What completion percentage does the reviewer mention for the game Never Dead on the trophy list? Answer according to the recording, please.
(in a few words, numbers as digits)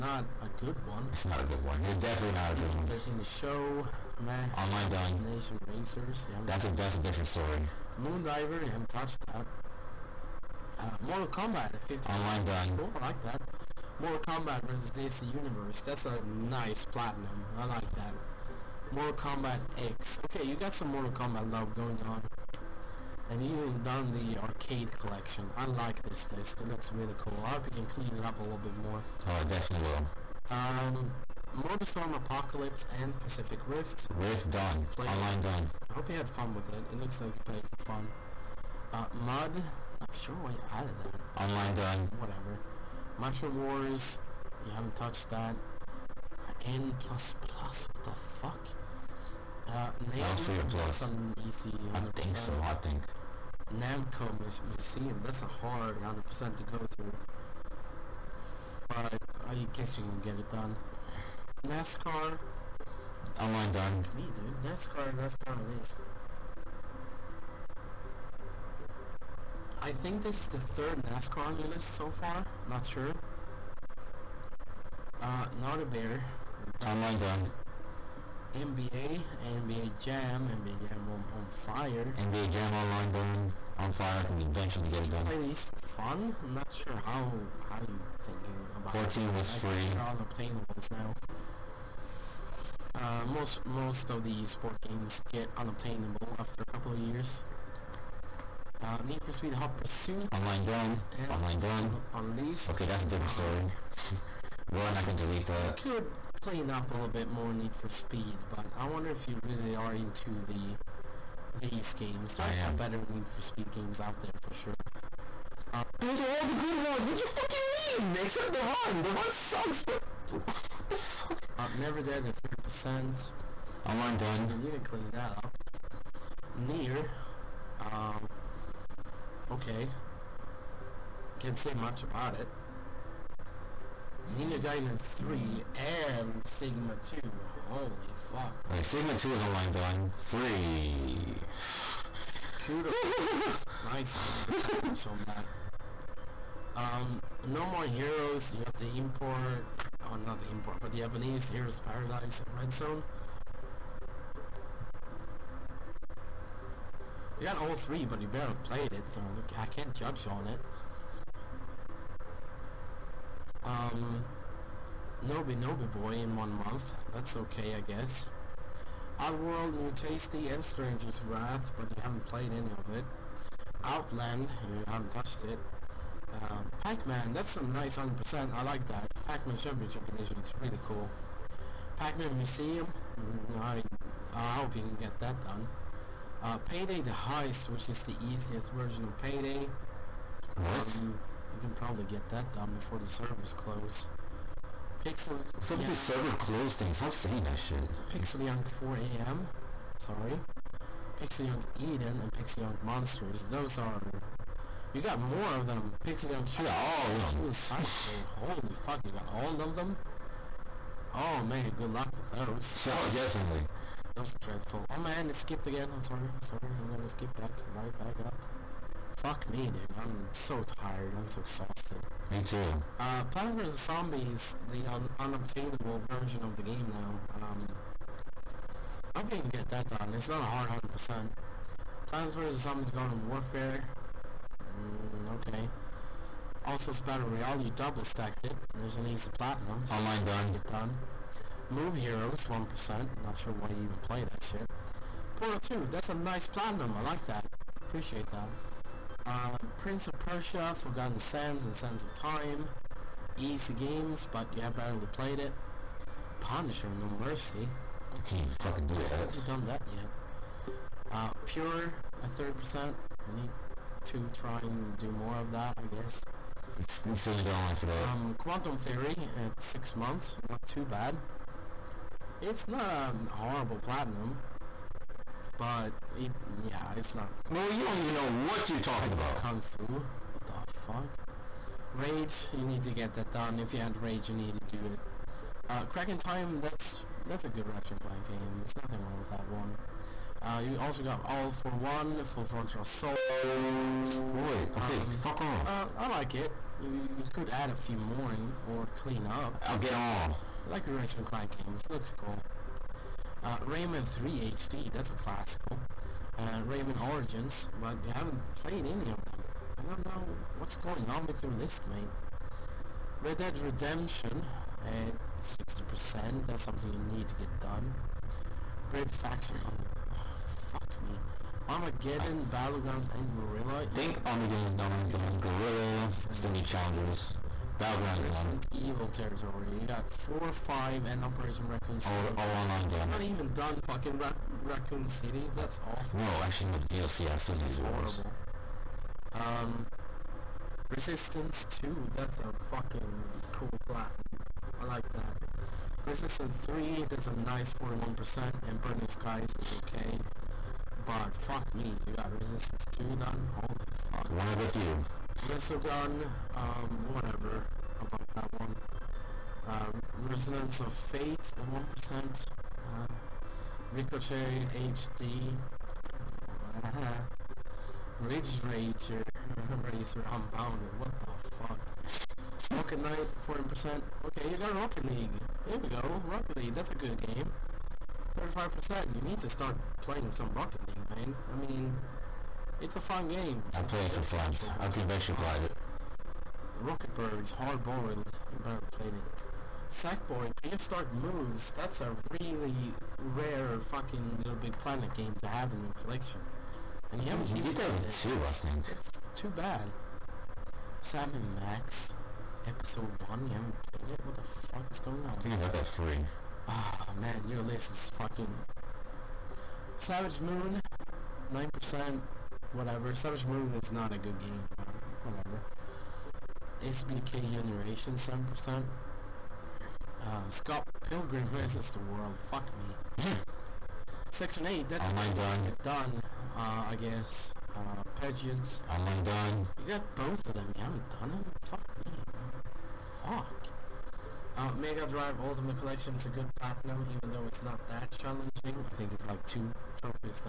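30%.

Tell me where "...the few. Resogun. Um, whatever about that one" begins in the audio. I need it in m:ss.
5:54.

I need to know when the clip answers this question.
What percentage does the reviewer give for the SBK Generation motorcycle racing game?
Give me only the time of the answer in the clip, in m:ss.
6:58.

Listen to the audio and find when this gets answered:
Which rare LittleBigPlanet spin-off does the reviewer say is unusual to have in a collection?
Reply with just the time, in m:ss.
6:29.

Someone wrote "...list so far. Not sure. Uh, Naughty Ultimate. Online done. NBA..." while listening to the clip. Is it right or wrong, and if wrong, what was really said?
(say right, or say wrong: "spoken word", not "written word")
wrong: "Bear", not "Ultimate".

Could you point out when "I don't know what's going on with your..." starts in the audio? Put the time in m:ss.
5:09.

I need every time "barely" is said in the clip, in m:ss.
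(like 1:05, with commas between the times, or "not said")
2:38, 4:14.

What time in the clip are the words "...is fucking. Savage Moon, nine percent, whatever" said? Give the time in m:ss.
6:47.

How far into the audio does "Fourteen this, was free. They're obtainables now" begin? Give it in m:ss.
1:28.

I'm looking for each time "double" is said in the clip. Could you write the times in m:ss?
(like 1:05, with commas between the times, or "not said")
3:57.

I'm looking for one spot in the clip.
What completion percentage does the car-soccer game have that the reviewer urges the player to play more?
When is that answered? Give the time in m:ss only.
6:18.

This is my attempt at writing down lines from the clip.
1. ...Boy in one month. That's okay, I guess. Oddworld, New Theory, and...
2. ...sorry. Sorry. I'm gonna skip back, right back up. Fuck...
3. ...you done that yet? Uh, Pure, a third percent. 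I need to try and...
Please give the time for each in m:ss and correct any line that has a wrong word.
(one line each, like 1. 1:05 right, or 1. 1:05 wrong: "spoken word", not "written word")
1. 2:46 wrong: "Tasty", not "Theory"
2. 3:36 right
3. 4:19 right.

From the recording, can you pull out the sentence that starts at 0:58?
But I guess you can get it done.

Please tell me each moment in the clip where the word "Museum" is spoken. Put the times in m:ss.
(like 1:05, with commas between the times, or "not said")
0:54, 3:02.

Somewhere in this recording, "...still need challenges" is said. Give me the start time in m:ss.
5:26.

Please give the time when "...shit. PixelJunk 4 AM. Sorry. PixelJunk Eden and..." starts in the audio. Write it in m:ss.
3:17.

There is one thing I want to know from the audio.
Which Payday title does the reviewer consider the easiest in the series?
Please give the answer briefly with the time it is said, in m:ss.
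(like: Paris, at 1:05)
Payday the Heist, at 3:06.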